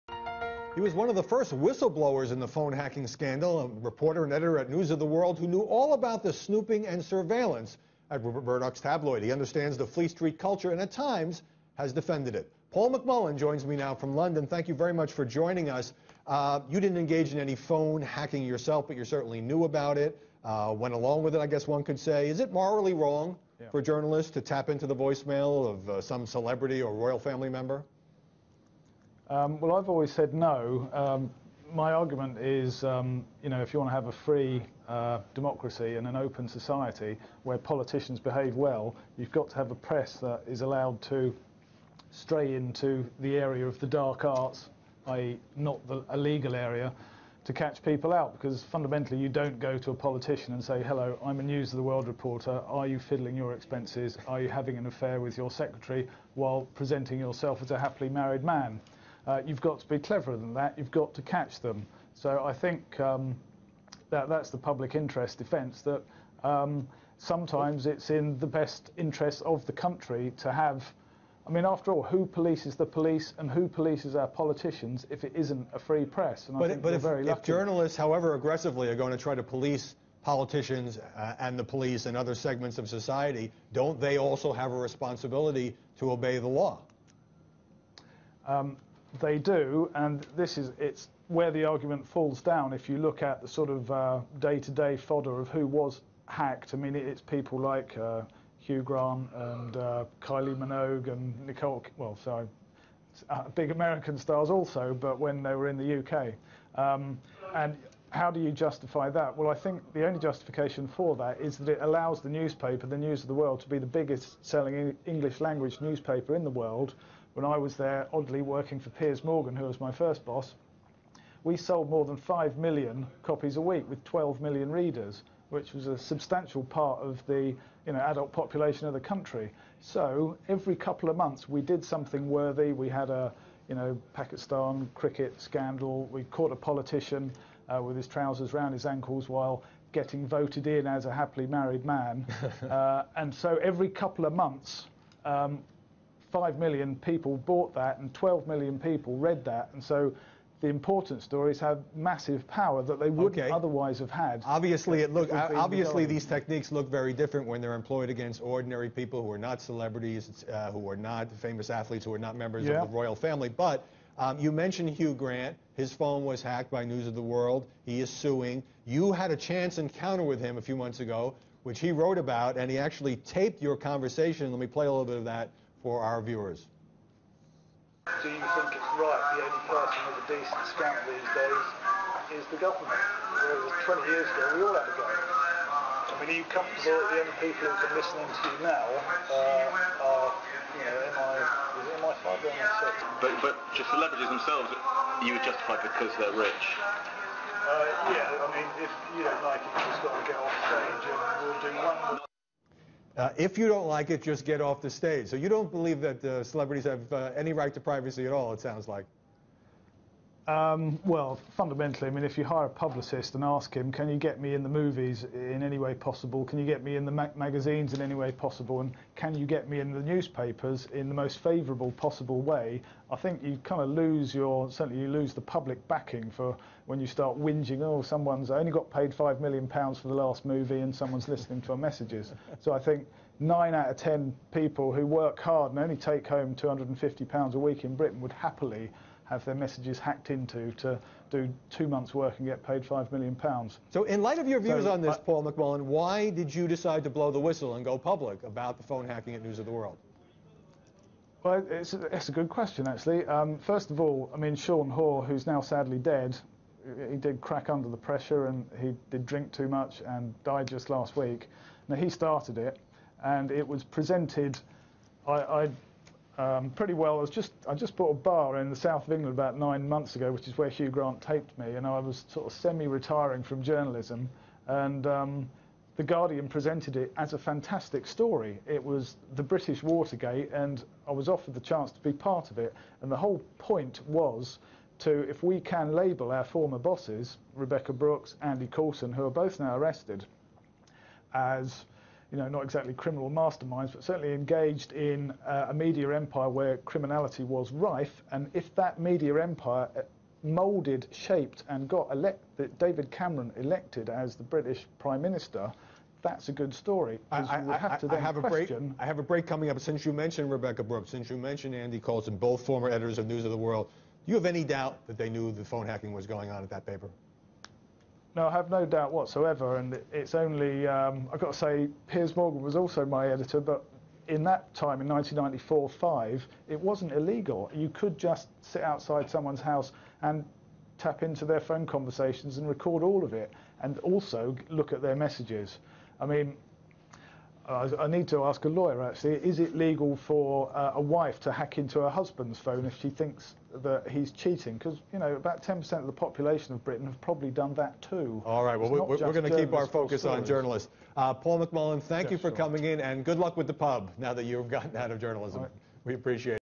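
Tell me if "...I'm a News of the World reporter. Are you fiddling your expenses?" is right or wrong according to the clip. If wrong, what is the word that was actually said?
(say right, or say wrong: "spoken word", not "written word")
right.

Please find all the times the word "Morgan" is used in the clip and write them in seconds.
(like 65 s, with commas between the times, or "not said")
119 s, 322 s.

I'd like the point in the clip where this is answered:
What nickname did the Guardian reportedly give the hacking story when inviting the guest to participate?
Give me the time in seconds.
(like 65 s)
279 s.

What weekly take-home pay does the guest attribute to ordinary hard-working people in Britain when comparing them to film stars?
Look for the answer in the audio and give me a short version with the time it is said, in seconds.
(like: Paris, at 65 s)
£250, at 236 s.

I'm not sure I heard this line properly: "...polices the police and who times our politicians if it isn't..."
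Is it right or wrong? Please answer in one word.
wrong.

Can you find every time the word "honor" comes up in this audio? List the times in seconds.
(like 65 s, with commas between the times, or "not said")
not said.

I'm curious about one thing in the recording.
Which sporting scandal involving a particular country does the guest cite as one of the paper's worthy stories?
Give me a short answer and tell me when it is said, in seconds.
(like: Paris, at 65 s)
Pakistan cricket scandal, at 134 s.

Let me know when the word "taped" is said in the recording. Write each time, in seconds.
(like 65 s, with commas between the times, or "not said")
173 s, 271 s.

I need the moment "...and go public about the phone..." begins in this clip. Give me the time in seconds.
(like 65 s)
247 s.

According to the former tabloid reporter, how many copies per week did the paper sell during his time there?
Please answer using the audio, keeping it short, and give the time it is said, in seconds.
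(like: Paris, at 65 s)
More than 5 million, at 121 s.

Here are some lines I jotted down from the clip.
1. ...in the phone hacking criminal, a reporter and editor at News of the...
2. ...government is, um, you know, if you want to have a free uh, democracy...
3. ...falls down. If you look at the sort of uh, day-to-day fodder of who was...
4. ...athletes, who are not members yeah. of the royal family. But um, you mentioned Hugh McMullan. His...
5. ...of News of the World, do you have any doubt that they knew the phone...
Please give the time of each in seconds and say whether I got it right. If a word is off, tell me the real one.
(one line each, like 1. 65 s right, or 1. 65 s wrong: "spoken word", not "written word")
1. 2 s wrong: "scandal", not "criminal"
2. 31 s wrong: "argument", not "government"
3. 92 s right
4. 161 s wrong: "Grant", not "McMullan"
5. 313 s right.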